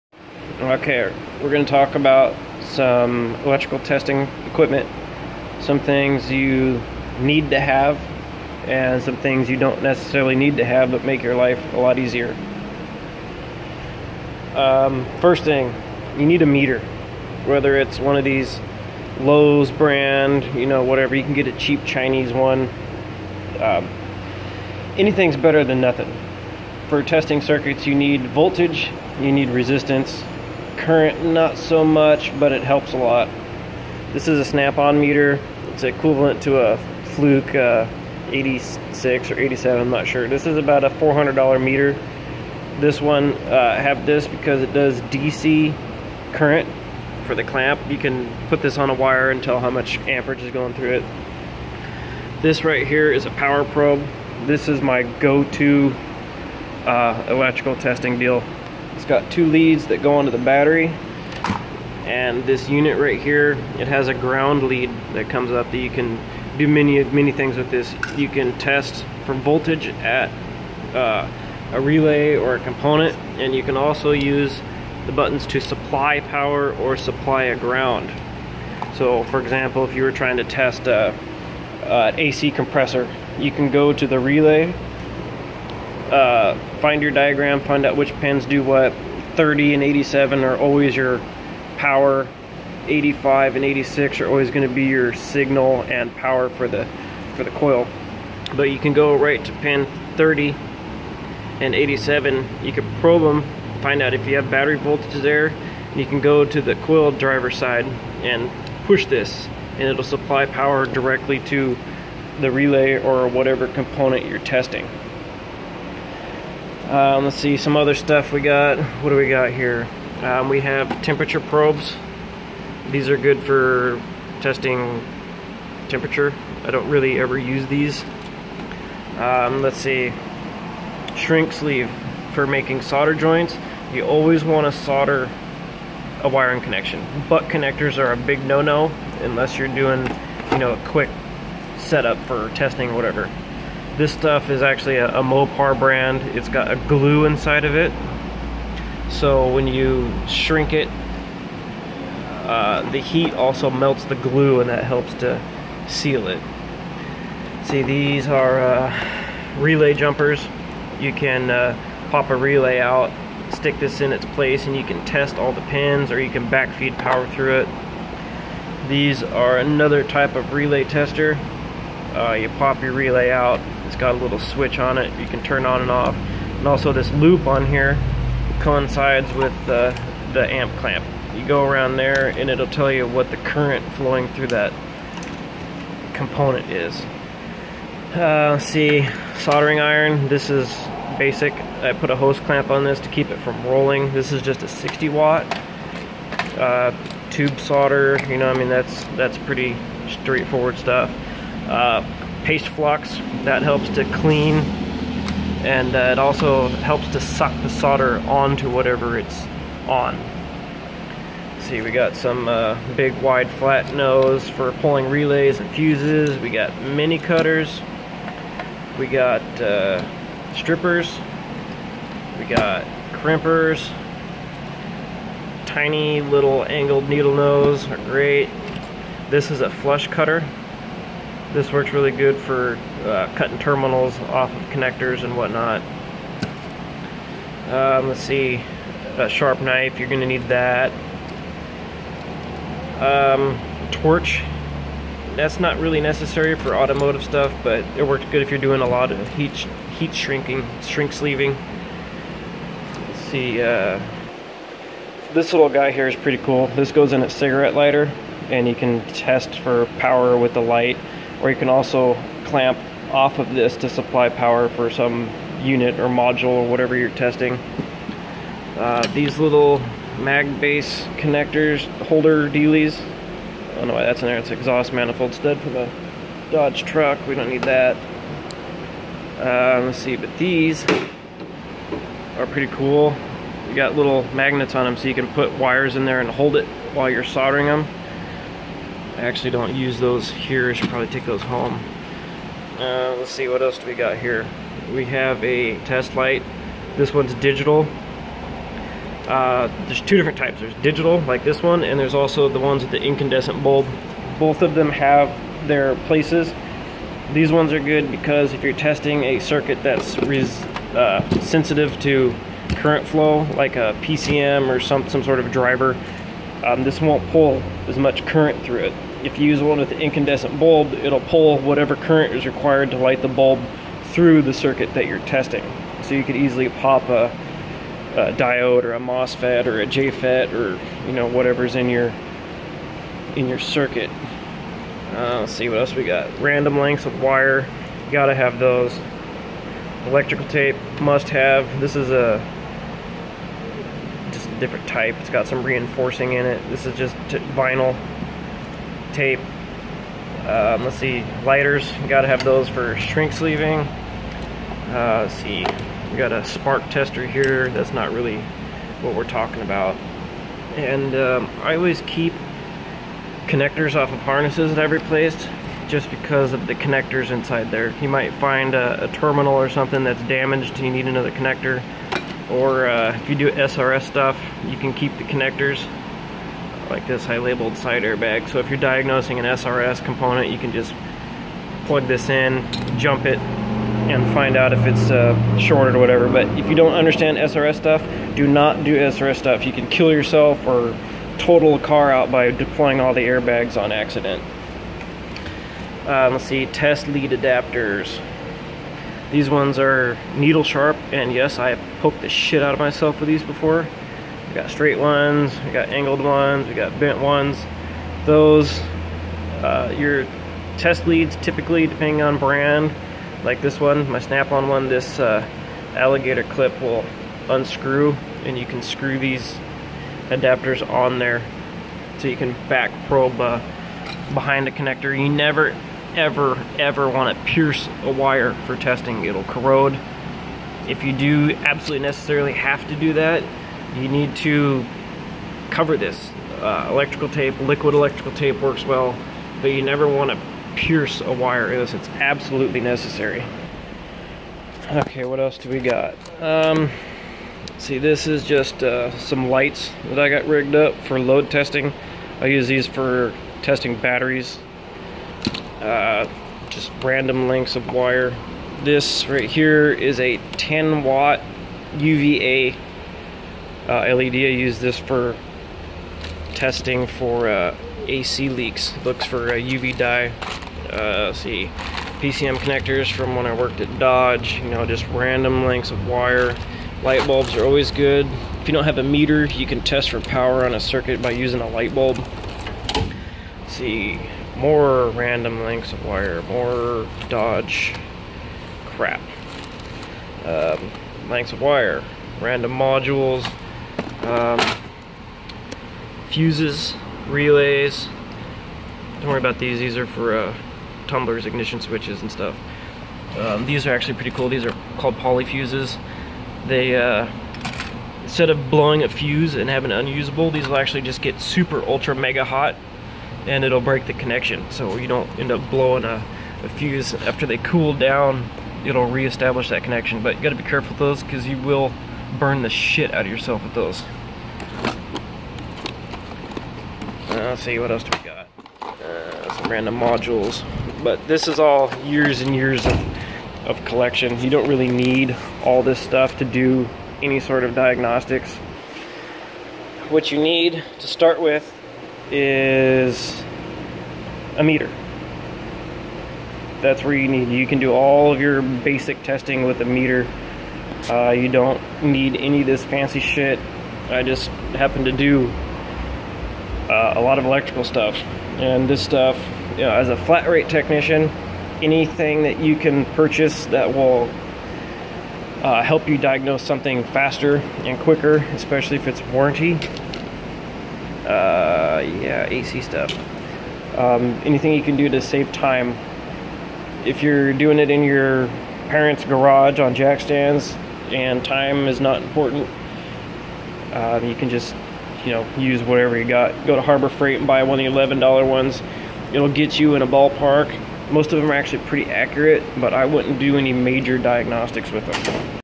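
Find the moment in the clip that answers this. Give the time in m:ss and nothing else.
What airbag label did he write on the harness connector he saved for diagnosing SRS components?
6:17.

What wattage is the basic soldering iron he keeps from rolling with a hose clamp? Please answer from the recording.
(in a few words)
60 watt.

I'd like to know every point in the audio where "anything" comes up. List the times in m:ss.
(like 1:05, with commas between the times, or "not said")
0:24, 9:21, 9:34.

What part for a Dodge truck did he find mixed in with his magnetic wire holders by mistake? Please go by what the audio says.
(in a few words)
exhaust manifold stud.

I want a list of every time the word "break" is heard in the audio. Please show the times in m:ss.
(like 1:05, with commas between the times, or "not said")
8:33.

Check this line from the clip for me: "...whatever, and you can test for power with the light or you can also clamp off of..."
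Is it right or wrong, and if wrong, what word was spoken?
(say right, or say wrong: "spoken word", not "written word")
wrong: "lighter", not "whatever".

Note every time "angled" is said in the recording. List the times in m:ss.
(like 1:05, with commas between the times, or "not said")
3:46, 6:45.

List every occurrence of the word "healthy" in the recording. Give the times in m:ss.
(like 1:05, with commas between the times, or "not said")
not said.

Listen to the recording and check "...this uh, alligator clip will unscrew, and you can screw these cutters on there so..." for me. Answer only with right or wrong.
wrong.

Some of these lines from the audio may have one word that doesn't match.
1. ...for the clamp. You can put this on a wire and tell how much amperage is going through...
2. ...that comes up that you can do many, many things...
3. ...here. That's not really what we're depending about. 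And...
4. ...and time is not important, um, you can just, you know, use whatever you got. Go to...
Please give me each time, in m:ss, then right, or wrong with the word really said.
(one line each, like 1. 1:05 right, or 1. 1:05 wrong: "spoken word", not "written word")
1. 0:47 right
2. 1:05 right
3. 5:57 wrong: "talking", not "depending"
4. 9:41 right.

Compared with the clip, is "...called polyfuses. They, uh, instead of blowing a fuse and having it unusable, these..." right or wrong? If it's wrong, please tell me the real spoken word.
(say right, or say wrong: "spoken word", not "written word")
right.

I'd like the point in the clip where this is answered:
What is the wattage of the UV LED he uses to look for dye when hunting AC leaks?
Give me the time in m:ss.
7:40.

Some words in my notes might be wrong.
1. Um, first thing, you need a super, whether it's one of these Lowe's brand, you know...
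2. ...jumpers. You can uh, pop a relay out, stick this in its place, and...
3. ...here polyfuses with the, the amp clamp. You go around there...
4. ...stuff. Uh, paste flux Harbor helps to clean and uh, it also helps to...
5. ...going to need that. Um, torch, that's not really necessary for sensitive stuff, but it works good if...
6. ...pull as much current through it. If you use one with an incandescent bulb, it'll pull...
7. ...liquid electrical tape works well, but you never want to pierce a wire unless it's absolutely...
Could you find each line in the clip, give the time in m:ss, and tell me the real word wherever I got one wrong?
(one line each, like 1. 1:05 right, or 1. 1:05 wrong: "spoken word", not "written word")
1. 0:14 wrong: "meter", not "super"
2. 2:39 right
3. 2:57 wrong: "coincides", not "polyfuses"
4. 3:20 wrong: "That", not "Harbor"
5. 4:00 wrong: "automotive", not "sensitive"
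6. 5:17 right
7. 7:17 right.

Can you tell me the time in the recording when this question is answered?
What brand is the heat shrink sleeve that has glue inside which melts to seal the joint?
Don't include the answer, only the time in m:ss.
2:25.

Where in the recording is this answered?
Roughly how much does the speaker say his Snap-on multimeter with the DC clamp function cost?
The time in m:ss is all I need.
0:40.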